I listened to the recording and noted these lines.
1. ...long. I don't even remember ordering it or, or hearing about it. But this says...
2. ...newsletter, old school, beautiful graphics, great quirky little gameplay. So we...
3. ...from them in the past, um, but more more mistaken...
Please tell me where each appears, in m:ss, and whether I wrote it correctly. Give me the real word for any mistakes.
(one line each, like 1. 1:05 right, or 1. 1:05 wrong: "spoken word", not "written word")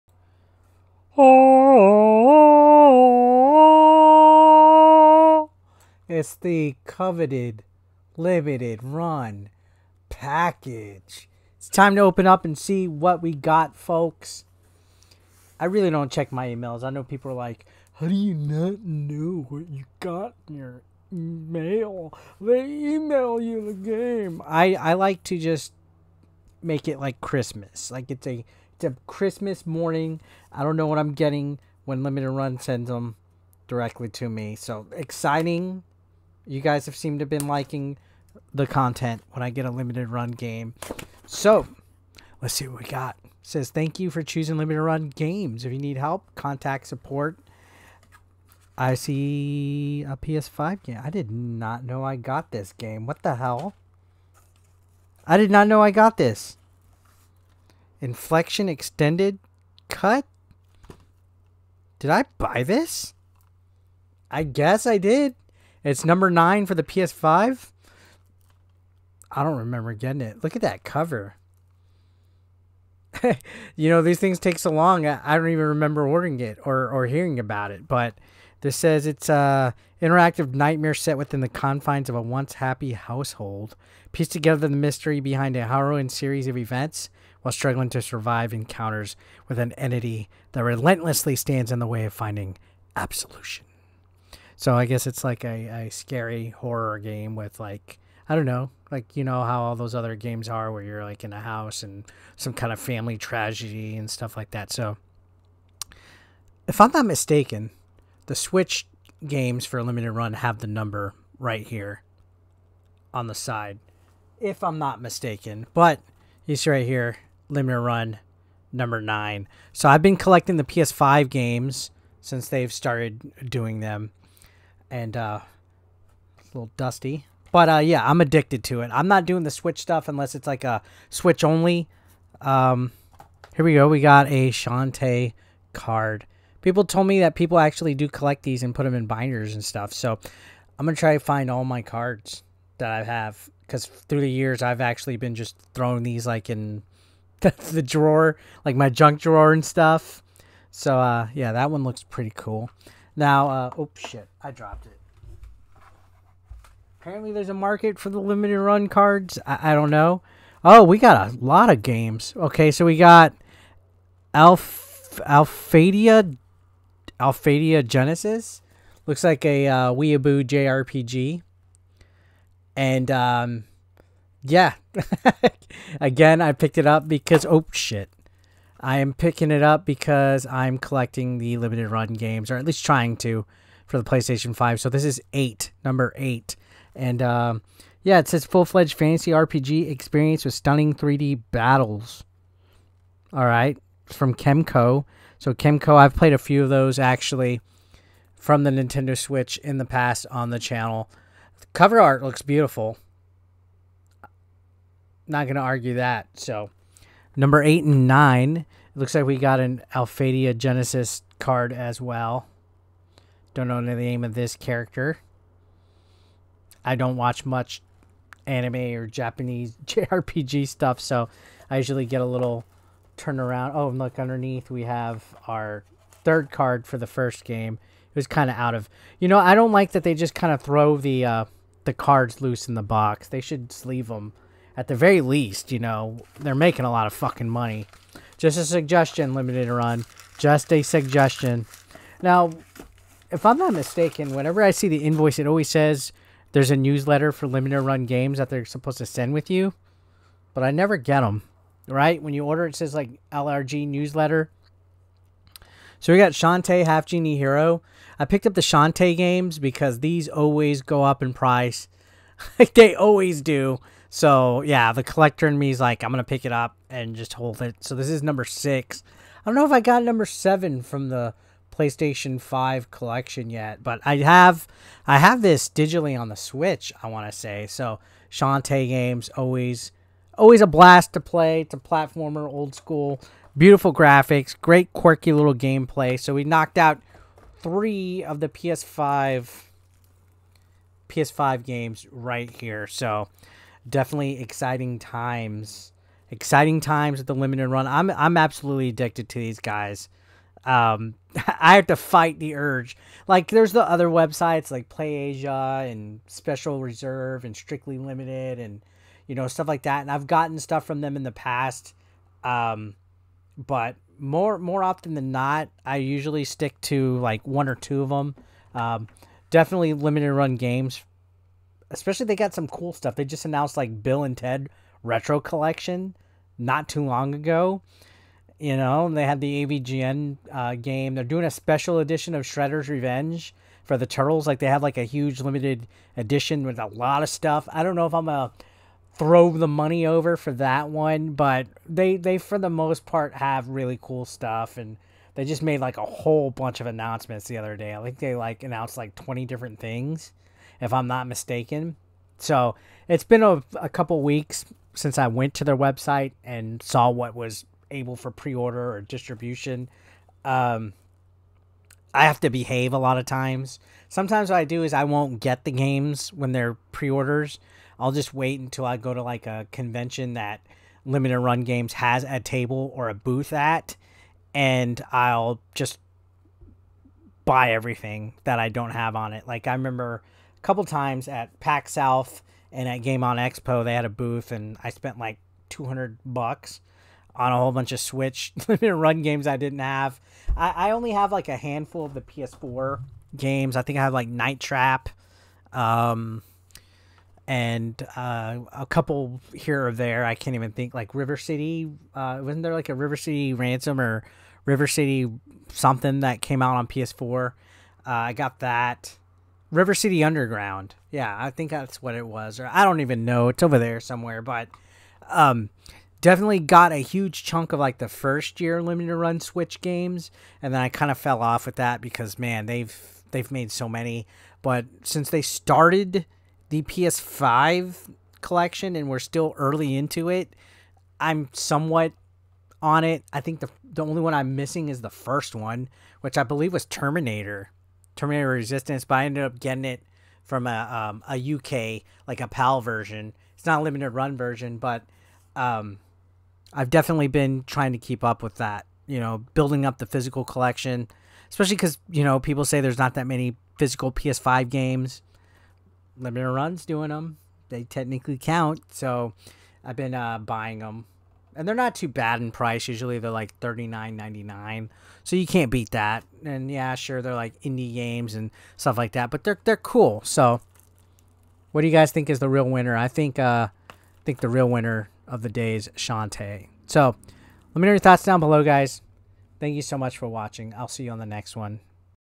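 1. 1:14 right
2. 4:41 wrong: "platformer", not "newsletter"
3. 5:10 wrong: "often", not "mistaken".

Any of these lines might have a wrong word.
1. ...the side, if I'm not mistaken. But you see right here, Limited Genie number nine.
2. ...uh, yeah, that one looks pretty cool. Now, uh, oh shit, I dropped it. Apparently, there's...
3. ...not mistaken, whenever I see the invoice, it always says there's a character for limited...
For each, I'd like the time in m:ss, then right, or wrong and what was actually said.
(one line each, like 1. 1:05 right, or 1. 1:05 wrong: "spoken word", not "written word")
1. 1:53 wrong: "Run", not "Genie"
2. 2:30 right
3. 4:03 wrong: "newsletter", not "character".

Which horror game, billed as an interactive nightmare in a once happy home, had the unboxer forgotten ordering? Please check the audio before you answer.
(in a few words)
Infliction Extended Cut.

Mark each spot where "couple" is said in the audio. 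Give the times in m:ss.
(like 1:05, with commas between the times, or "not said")
5:53, 6:20, 6:38.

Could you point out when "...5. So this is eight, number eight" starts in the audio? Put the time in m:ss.
3:04.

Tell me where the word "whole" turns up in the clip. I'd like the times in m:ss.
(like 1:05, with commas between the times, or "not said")
5:46, 6:27.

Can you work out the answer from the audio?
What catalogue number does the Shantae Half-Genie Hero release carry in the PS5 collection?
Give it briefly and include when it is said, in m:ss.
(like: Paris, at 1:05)
6, at 4:28.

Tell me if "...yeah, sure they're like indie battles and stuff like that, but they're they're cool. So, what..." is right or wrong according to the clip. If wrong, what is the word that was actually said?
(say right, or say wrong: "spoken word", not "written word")
wrong: "games", not "battles".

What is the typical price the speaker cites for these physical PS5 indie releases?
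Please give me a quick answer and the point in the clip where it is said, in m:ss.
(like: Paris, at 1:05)
$39.99, at 7:43.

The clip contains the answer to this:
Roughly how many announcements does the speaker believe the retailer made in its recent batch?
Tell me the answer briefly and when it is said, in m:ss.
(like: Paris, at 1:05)
20, at 5:49.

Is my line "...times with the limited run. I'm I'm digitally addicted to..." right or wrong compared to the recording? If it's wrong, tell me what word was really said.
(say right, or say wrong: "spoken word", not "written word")
wrong: "absolutely", not "digitally".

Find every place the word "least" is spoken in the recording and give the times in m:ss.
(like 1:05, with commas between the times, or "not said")
3:02, 3:55.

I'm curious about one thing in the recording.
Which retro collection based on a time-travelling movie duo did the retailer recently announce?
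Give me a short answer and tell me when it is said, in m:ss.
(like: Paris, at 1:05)
Bill and Ted Retro Collection, at 5:24.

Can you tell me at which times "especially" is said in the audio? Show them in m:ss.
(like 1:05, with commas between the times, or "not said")
5:21, 7:31.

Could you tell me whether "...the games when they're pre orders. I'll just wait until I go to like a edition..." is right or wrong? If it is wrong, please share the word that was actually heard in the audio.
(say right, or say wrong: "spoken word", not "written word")
wrong: "convention", not "edition".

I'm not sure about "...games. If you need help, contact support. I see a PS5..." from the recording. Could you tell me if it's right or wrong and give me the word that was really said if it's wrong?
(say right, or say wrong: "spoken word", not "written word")
right.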